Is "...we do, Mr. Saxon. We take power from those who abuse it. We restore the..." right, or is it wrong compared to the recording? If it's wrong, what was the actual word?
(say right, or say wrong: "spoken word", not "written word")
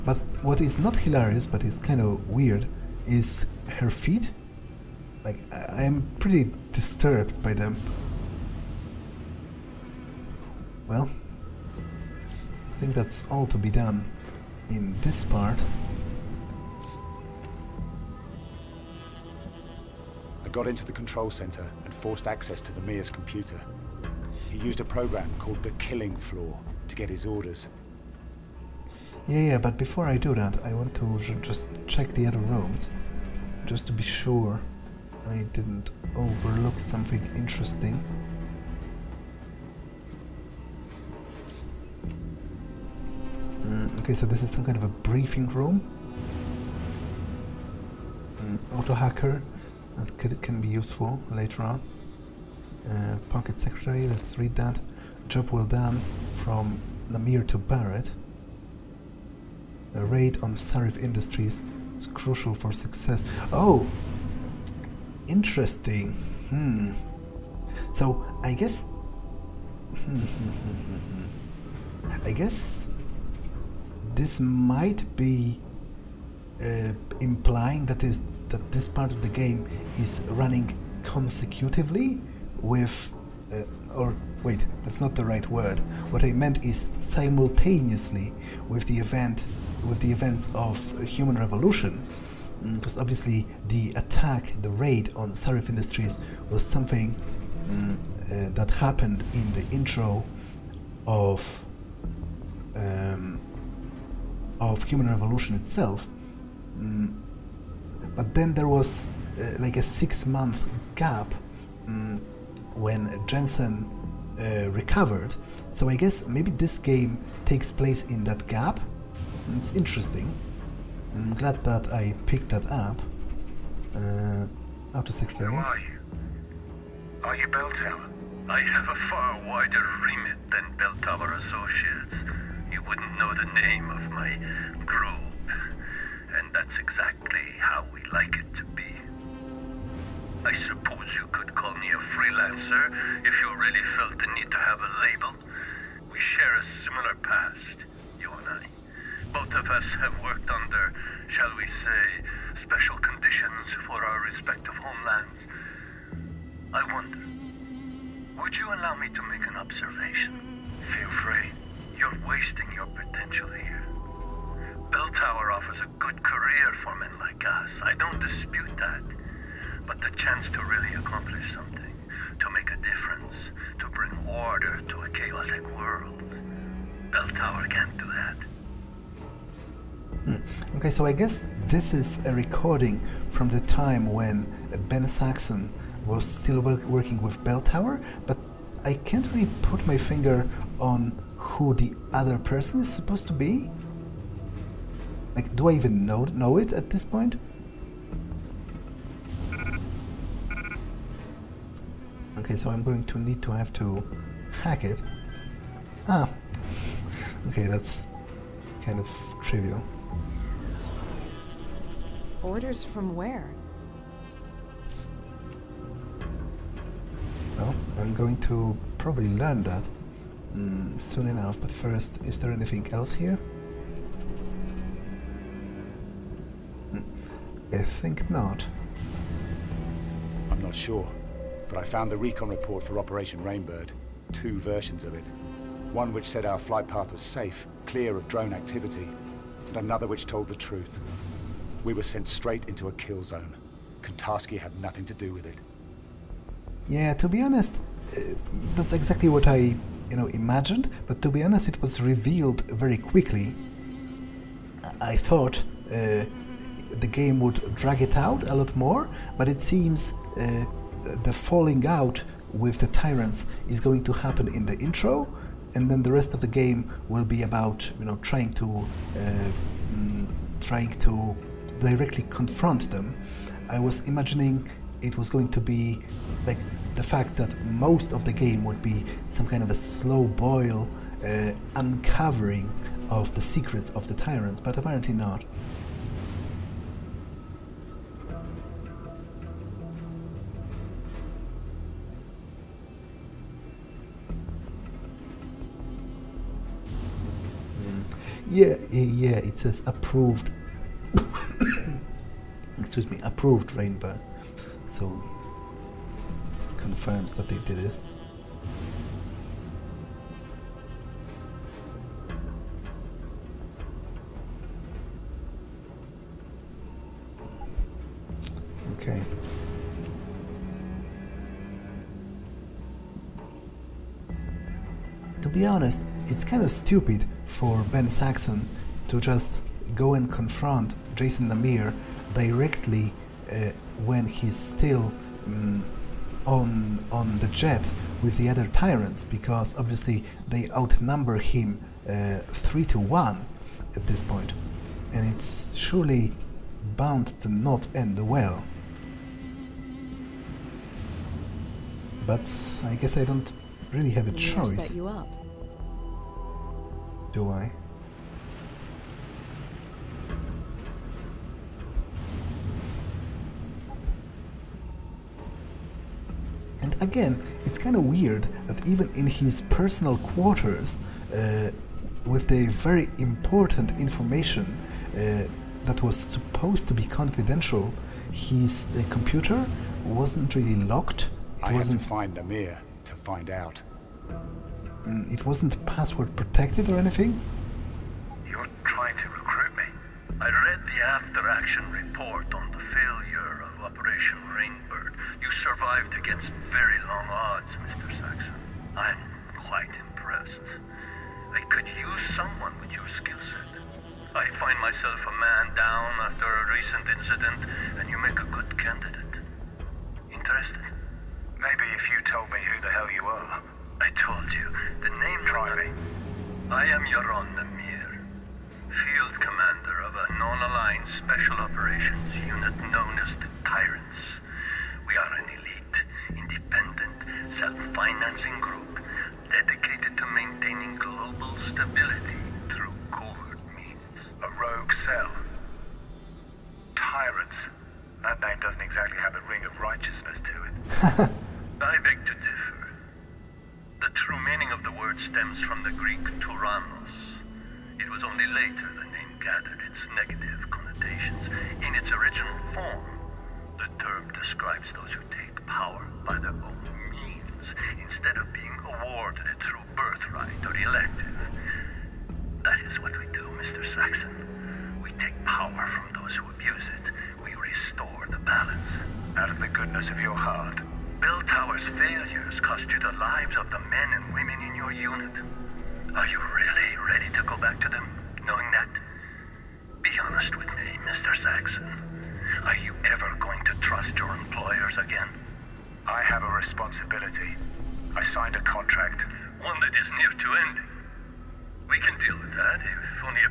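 right.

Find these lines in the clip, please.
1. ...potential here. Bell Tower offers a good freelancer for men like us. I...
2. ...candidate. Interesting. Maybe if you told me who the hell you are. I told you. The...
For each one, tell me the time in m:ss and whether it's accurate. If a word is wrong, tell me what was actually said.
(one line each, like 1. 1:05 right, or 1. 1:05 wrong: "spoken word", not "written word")
1. 2:42 wrong: "career", not "freelancer"
2. 6:48 right.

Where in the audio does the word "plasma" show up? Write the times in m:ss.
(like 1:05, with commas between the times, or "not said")
not said.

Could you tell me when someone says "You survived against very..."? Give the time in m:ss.
6:35.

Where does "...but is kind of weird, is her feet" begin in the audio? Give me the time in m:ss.
0:01.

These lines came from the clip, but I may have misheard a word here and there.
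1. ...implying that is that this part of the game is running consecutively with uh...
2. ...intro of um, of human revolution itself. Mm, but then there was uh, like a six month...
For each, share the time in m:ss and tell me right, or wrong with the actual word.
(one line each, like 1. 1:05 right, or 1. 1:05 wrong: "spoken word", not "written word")
1. 1:17 right
2. 1:39 right.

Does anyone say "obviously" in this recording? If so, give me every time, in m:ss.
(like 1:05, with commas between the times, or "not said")
1:33, 5:39.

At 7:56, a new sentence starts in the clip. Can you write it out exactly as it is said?
Are you really ready to go back to them, knowing that?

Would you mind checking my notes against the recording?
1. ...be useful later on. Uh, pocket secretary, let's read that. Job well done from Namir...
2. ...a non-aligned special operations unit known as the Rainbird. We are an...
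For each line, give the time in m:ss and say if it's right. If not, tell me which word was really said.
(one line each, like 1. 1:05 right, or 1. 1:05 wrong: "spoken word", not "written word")
1. 0:50 right
2. 7:00 wrong: "Tyrants", not "Rainbird".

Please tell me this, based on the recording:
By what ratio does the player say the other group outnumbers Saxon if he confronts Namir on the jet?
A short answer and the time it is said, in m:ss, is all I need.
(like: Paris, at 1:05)
3 to 1, at 5:42.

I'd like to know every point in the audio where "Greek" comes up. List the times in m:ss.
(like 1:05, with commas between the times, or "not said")
7:25.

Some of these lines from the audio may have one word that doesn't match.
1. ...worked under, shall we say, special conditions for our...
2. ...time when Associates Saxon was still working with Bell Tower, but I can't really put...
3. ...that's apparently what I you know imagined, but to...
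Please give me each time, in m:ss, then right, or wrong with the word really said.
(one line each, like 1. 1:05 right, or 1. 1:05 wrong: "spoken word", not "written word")
1. 2:30 right
2. 3:03 wrong: "Ben", not "Associates"
3. 4:08 wrong: "exactly", not "apparently".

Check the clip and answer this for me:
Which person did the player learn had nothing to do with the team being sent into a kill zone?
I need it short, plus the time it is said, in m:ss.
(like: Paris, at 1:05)
Kantarski, at 4:04.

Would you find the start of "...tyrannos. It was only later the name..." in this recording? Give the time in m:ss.
7:26.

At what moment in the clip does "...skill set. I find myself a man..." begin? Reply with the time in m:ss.
6:43.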